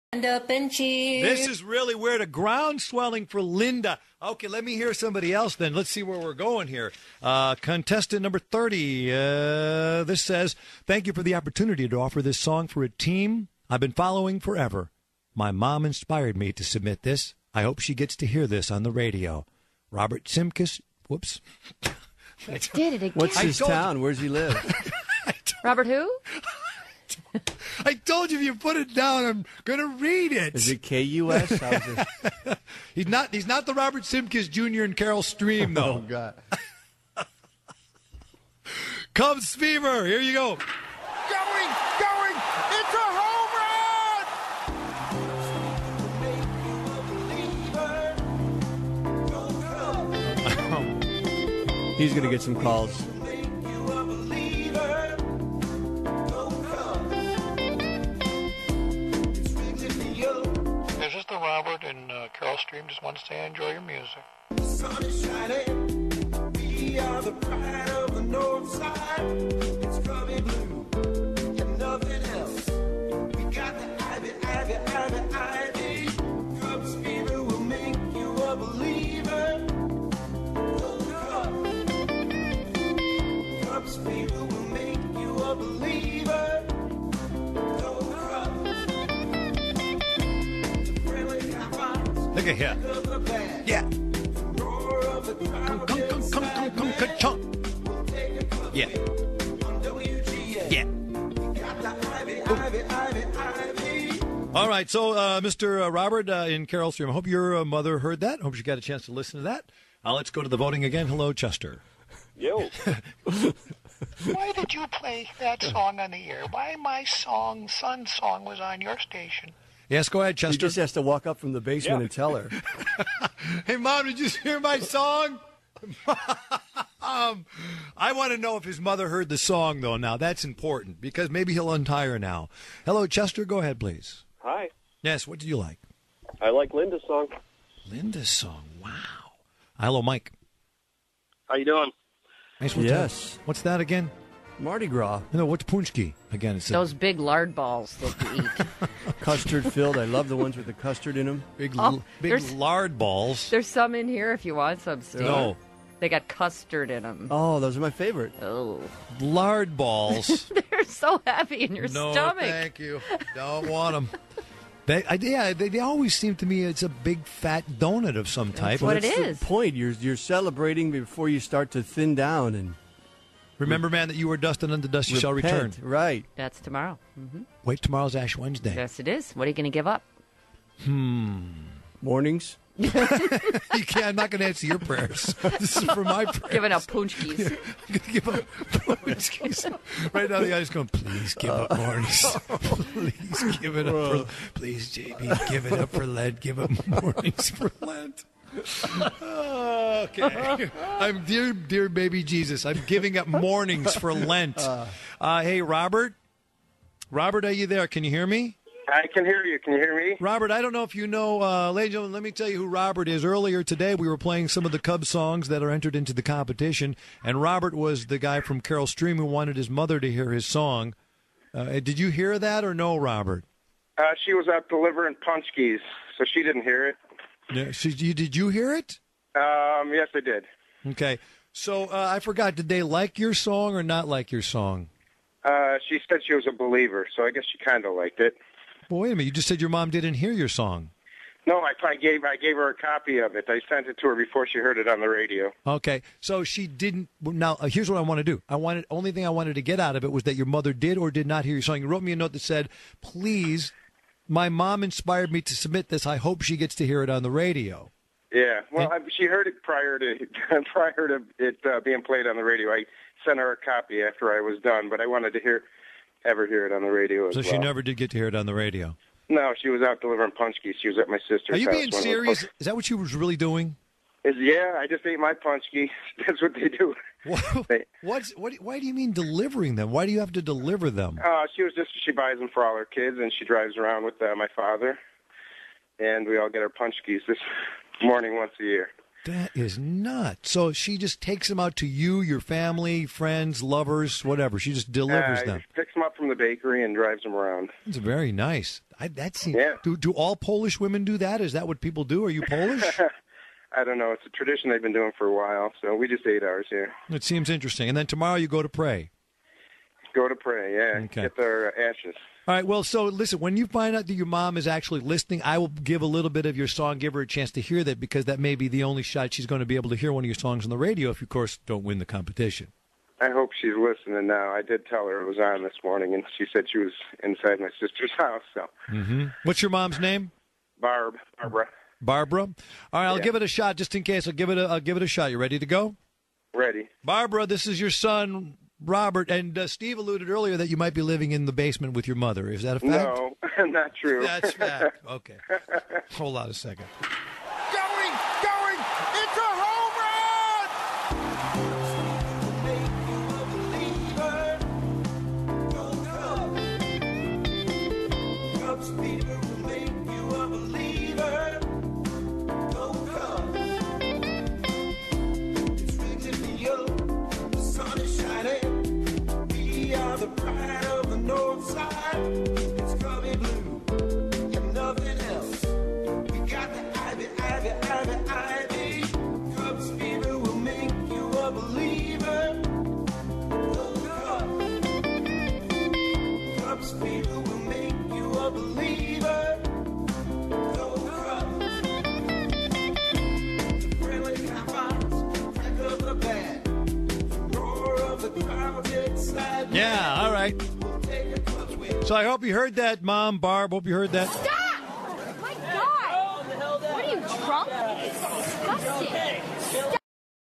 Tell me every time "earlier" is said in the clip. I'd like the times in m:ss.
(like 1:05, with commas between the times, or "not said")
3:33, 5:40.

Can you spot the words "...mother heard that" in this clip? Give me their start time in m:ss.
1:47.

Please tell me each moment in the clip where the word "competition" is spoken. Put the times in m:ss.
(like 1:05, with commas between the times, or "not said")
3:36, 5:22.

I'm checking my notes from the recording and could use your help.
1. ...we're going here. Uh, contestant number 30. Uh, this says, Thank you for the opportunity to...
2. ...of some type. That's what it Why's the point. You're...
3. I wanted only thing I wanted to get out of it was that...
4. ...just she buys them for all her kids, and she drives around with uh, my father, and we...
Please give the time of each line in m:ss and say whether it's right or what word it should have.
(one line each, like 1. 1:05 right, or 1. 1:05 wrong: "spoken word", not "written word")
1. 0:06 right
2. 2:48 wrong: "That", not "Why"
3. 4:08 right
4. 4:41 right.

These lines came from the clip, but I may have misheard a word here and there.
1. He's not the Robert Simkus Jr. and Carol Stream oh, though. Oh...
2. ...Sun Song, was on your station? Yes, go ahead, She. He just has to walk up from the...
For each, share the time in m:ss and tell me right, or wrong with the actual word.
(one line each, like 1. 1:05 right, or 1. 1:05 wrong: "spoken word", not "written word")
1. 0:33 right
2. 1:57 wrong: "Chester", not "She".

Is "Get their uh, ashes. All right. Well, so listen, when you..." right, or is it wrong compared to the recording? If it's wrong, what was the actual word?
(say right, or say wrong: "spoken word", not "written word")
right.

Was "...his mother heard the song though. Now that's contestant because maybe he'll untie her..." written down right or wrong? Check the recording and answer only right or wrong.
wrong.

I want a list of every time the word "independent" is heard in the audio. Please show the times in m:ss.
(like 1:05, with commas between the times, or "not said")
not said.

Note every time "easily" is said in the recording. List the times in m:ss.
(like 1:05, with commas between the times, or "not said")
not said.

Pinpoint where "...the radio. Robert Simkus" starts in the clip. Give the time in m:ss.
0:18.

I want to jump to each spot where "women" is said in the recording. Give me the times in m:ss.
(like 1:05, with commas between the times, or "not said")
5:00.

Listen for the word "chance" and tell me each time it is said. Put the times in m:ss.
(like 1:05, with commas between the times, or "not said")
1:48, 5:17.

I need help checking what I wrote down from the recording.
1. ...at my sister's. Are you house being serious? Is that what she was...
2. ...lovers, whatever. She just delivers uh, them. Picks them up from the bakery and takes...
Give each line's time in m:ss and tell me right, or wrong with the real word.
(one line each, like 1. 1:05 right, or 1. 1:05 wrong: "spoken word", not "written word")
1. 4:30 right
2. 4:53 wrong: "drives", not "takes".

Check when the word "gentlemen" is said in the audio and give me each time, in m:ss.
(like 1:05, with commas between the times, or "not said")
3:31.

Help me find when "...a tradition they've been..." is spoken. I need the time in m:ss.
5:04.